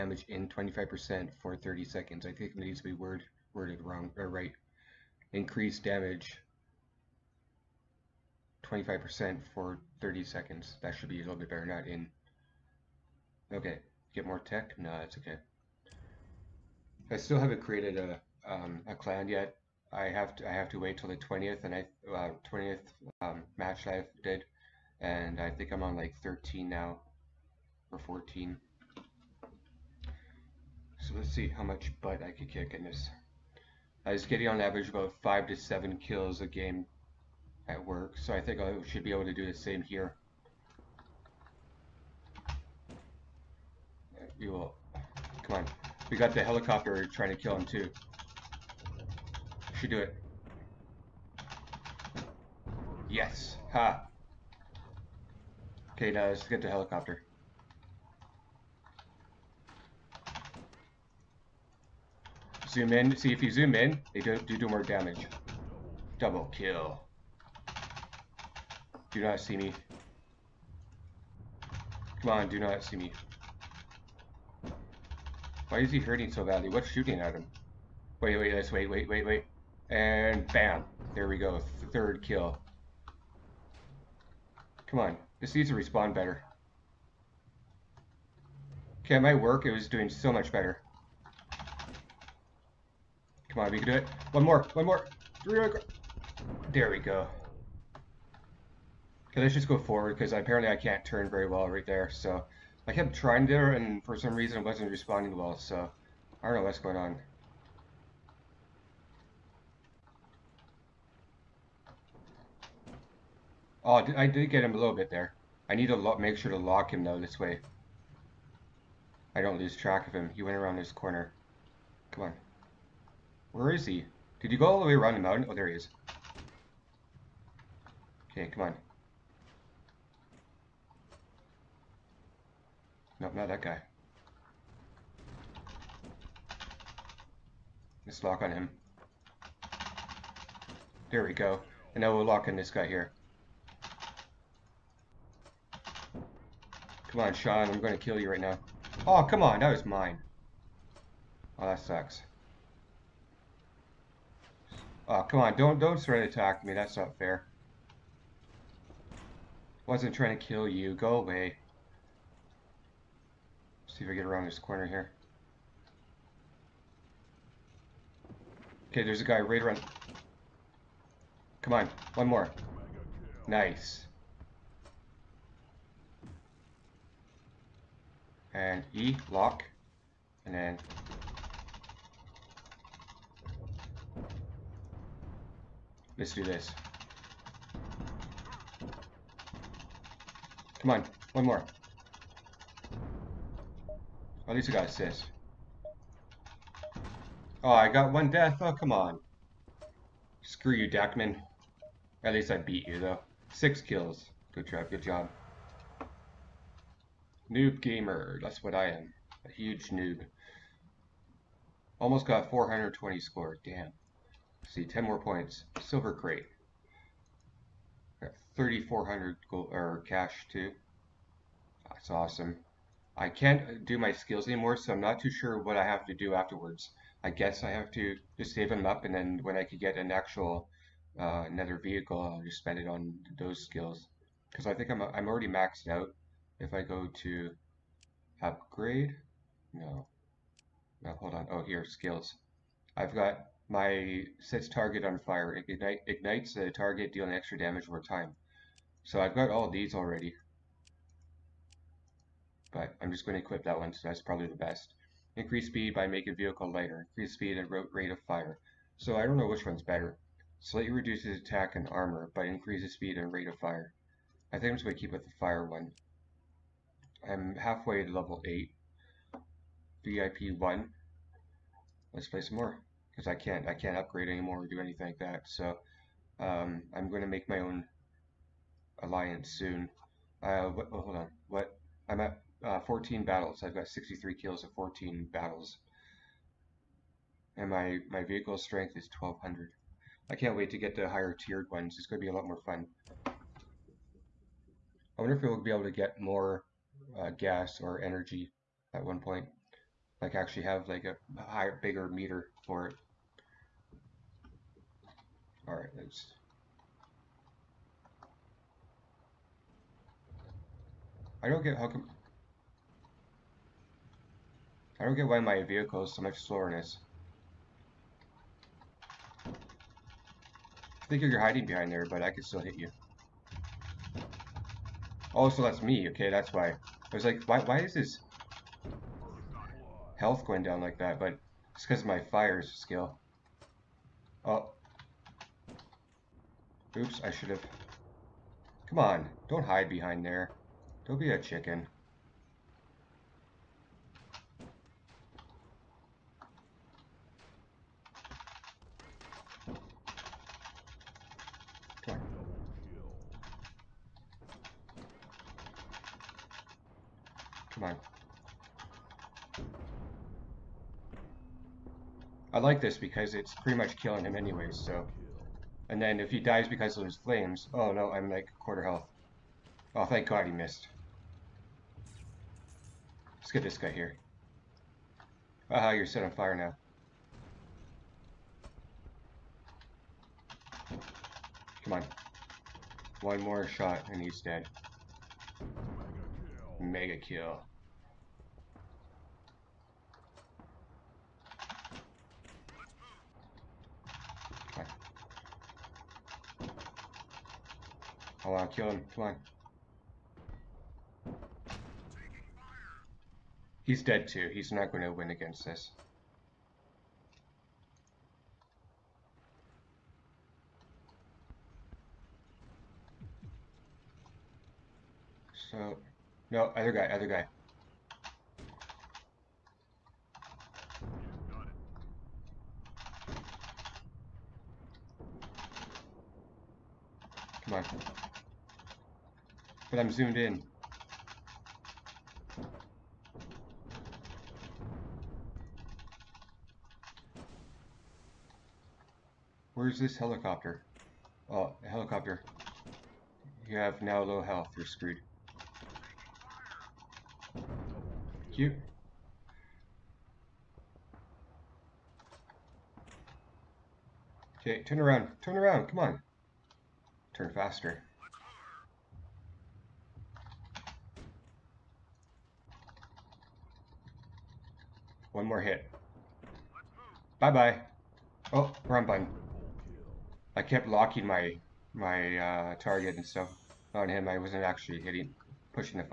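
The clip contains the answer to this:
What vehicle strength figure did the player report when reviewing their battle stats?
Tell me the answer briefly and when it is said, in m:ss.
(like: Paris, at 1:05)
1200, at 4:49.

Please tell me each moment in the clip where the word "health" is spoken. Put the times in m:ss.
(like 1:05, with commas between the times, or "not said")
5:30, 6:08, 7:24.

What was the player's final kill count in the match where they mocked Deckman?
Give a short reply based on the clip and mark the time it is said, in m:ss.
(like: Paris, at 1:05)
6, at 3:23.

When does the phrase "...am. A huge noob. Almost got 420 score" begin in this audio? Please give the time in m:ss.
3:28.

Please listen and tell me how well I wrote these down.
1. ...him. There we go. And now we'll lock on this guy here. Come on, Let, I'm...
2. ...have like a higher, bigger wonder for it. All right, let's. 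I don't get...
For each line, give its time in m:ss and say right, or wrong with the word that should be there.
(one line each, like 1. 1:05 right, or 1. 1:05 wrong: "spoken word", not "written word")
1. 2:18 wrong: "Sean", not "Let"
2. 5:00 wrong: "meter", not "wonder".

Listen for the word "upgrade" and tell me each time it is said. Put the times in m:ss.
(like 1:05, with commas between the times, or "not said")
3:58, 4:33.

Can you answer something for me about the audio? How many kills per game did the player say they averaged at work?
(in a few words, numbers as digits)
five to seven.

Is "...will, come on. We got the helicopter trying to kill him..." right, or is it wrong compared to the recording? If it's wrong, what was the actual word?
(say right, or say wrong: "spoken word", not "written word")
right.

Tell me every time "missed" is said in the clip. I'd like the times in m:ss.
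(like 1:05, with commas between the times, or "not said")
6:10.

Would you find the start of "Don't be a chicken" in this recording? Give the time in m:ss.
5:41.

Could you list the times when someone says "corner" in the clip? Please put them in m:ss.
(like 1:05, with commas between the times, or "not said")
2:00, 2:44.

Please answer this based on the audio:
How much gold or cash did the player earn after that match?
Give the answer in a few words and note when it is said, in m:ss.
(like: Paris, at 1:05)
3,400, at 3:38.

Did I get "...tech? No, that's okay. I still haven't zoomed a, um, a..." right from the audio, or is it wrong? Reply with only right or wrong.
wrong.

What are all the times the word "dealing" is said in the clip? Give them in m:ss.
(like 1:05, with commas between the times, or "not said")
4:07.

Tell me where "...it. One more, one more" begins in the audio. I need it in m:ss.
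1:33.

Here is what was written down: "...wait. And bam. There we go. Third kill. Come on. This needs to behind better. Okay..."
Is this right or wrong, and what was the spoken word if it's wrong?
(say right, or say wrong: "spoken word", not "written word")
wrong: "respond", not "behind".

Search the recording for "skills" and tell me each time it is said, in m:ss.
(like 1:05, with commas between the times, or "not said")
3:44, 3:53, 4:01, 5:32.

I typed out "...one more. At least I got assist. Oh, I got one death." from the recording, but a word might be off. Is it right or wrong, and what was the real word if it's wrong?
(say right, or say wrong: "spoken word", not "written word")
right.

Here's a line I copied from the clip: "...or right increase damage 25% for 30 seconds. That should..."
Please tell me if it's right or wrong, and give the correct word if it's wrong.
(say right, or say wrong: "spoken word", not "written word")
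right.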